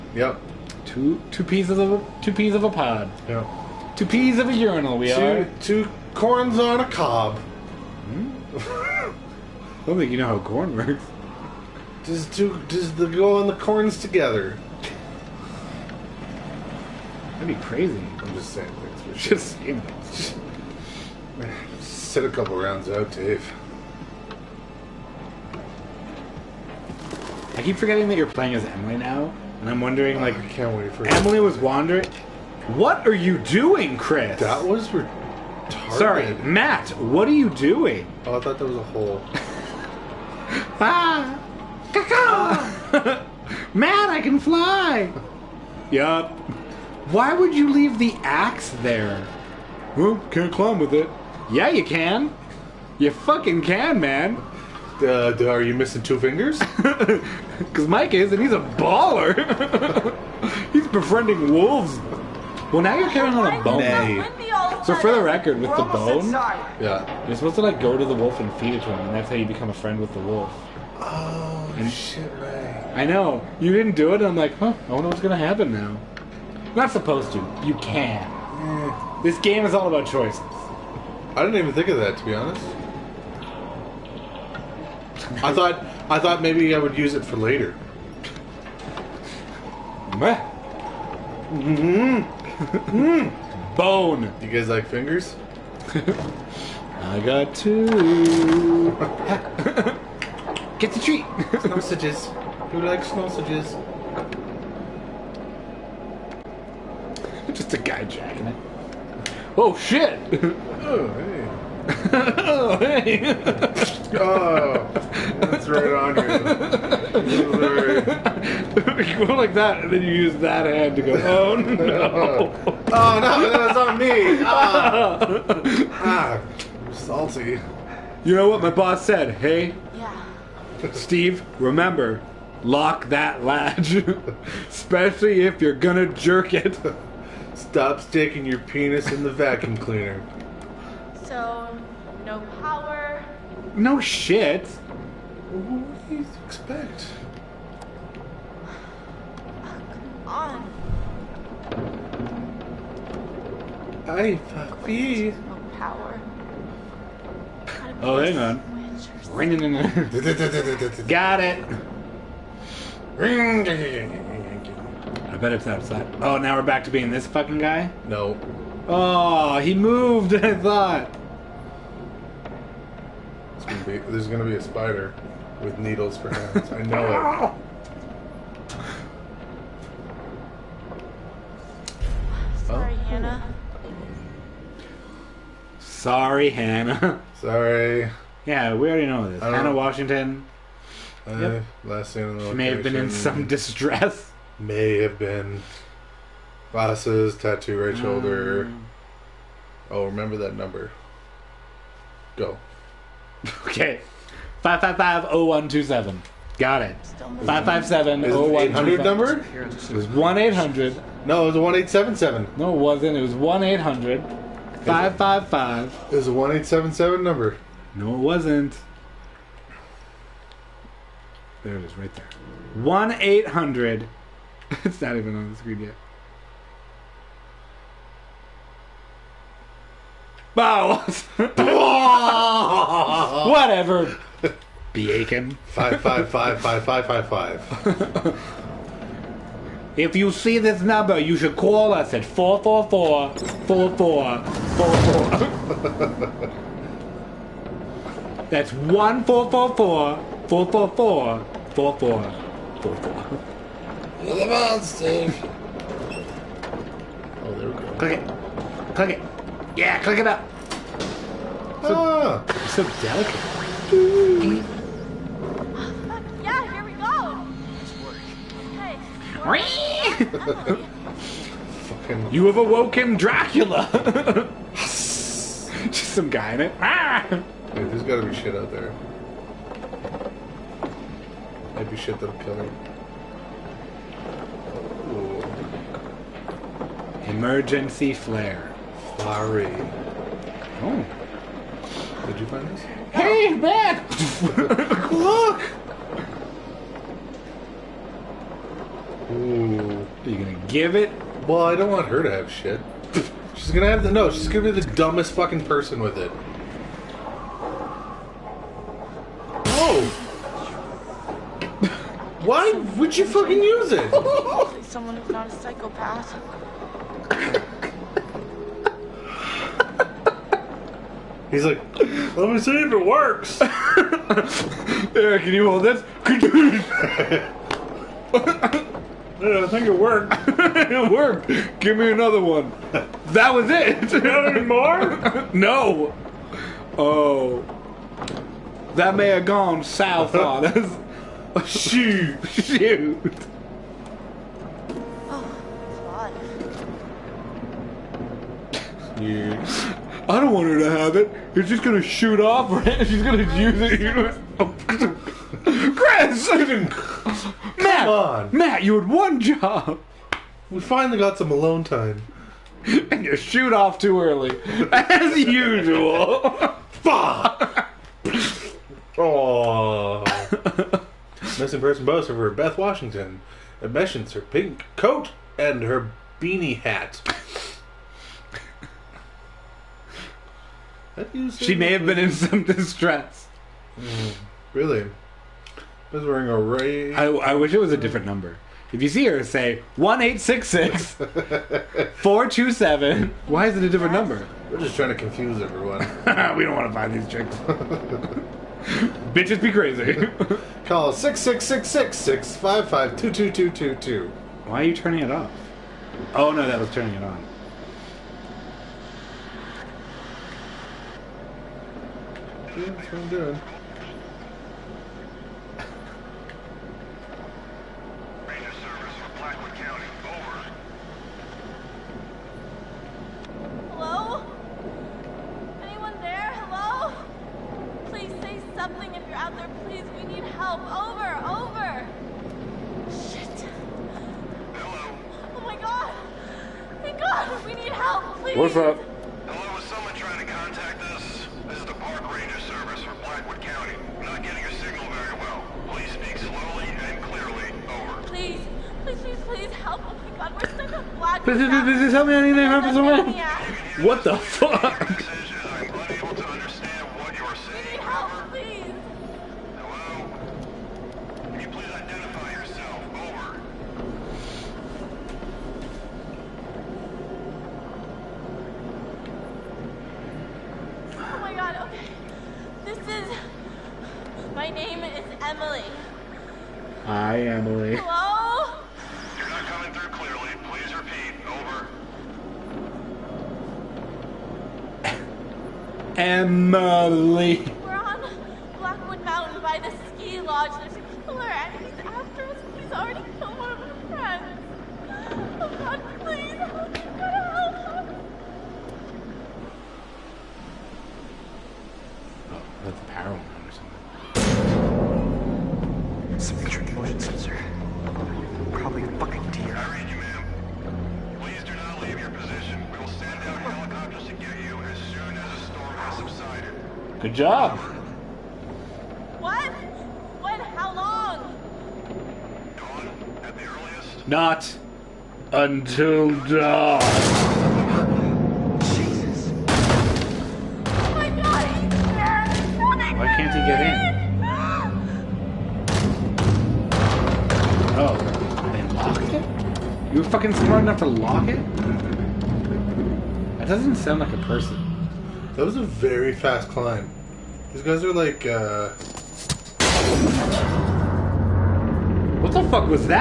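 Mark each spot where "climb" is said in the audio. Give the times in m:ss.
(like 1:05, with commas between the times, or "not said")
0:50, 9:06.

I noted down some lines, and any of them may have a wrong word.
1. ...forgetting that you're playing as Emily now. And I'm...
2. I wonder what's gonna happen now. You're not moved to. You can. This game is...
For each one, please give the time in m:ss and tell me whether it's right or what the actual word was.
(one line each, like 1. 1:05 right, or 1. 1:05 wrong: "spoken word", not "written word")
1. 0:27 right
2. 1:14 wrong: "supposed", not "moved".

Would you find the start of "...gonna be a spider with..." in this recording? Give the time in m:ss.
2:54.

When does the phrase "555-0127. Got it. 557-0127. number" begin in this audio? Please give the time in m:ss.
3:24.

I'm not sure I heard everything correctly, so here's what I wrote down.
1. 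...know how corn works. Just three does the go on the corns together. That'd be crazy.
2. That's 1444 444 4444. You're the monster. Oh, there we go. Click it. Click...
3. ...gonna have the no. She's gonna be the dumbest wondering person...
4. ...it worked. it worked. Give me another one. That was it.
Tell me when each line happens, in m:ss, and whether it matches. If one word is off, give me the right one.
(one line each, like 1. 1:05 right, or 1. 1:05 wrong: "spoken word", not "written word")
1. 0:10 wrong: "two", not "three"
2. 4:08 right
3. 5:03 wrong: "fucking", not "wondering"
4. 5:29 right.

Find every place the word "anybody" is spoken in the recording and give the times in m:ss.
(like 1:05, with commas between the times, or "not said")
not said.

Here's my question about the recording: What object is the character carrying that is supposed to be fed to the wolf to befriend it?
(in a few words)
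a bone.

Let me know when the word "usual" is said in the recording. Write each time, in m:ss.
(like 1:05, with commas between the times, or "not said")
6:05.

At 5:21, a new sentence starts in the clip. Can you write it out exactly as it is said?
He's like, let me see if it works.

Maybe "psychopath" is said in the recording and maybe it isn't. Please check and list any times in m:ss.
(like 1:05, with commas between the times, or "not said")
5:15.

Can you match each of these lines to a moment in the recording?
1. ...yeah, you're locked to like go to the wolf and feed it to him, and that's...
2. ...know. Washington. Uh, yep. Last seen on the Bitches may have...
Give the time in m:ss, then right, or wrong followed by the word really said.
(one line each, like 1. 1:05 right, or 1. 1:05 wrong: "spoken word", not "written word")
1. 1:06 wrong: "supposed", not "locked"
2. 3:09 wrong: "She", not "Bitches".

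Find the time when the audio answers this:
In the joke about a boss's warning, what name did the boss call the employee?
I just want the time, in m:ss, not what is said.
2:10.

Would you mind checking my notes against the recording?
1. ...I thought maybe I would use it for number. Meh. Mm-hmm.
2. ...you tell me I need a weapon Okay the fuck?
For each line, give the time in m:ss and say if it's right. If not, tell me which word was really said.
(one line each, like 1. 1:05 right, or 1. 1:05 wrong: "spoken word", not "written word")
1. 1:26 wrong: "later", not "number"
2. 7:32 wrong: "What", not "Okay".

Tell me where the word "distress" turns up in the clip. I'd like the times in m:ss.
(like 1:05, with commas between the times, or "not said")
3:13, 6:22.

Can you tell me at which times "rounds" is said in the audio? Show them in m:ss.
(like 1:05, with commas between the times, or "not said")
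0:22.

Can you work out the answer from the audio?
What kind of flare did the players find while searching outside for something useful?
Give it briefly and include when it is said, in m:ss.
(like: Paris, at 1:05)
Emergency flare, at 4:47.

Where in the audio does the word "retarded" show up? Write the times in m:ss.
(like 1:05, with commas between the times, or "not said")
0:34.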